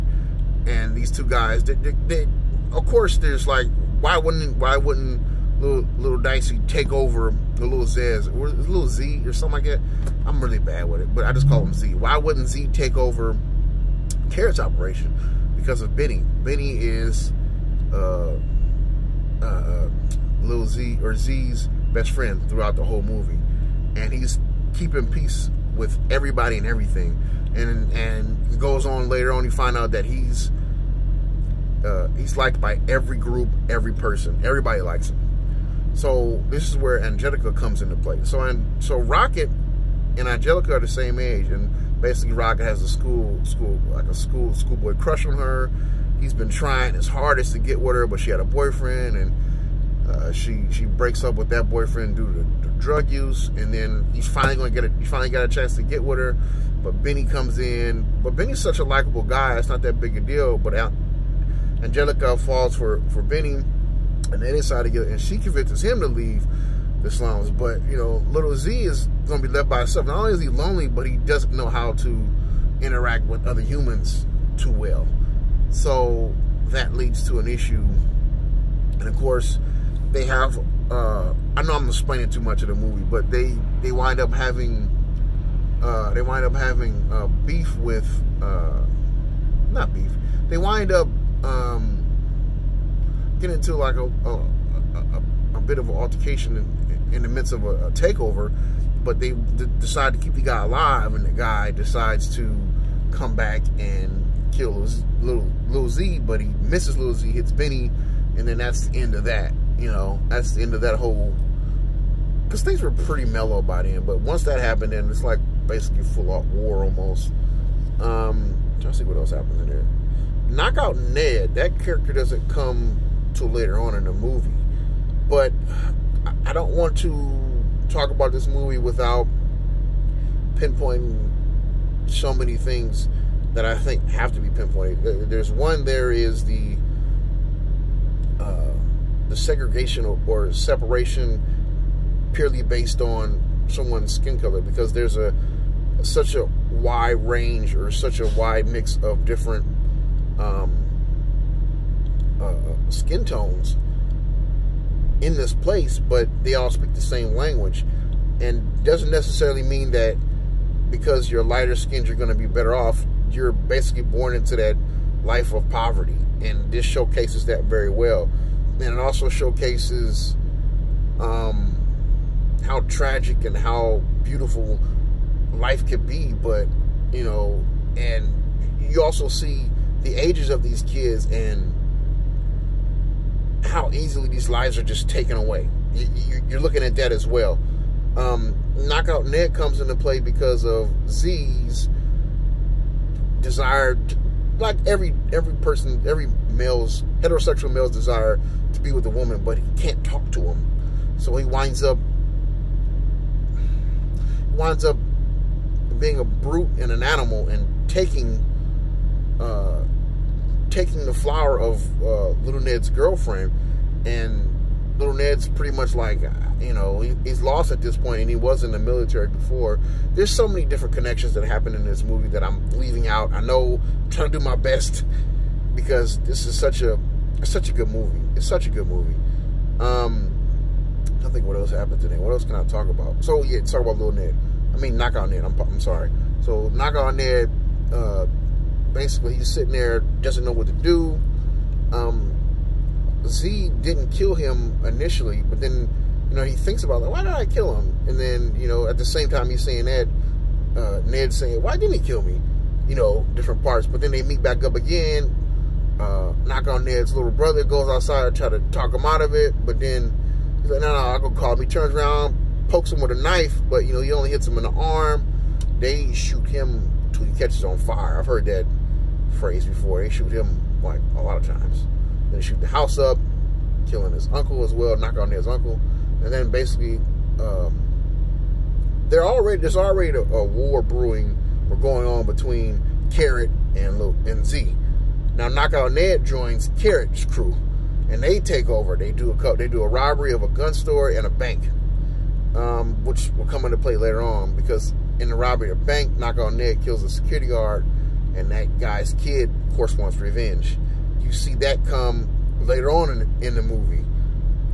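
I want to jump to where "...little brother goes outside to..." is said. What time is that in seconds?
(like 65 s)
257 s.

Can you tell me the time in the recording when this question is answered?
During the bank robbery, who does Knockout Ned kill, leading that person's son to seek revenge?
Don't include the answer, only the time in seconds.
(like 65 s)
297 s.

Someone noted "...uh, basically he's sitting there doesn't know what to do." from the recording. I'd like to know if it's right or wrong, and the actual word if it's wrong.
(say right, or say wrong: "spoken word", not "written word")
right.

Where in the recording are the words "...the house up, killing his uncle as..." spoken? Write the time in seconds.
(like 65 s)
272 s.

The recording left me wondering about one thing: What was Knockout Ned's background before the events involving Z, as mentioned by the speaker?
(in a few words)
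The military.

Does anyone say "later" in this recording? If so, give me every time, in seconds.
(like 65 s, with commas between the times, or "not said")
29 s, 123 s, 293 s, 302 s.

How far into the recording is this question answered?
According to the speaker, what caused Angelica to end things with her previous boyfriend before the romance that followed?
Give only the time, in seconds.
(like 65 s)
52 s.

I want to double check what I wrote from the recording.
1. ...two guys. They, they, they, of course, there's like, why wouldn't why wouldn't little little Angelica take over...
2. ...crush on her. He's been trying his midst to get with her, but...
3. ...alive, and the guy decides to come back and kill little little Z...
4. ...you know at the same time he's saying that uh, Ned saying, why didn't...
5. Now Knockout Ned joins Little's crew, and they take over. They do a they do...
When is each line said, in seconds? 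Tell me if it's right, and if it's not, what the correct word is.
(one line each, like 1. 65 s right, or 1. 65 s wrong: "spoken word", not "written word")
1. 1 s wrong: "Dicey", not "Angelica"
2. 44 s wrong: "hardest", not "midst"
3. 100 s right
4. 248 s right
5. 285 s wrong: "Carrot", not "Little".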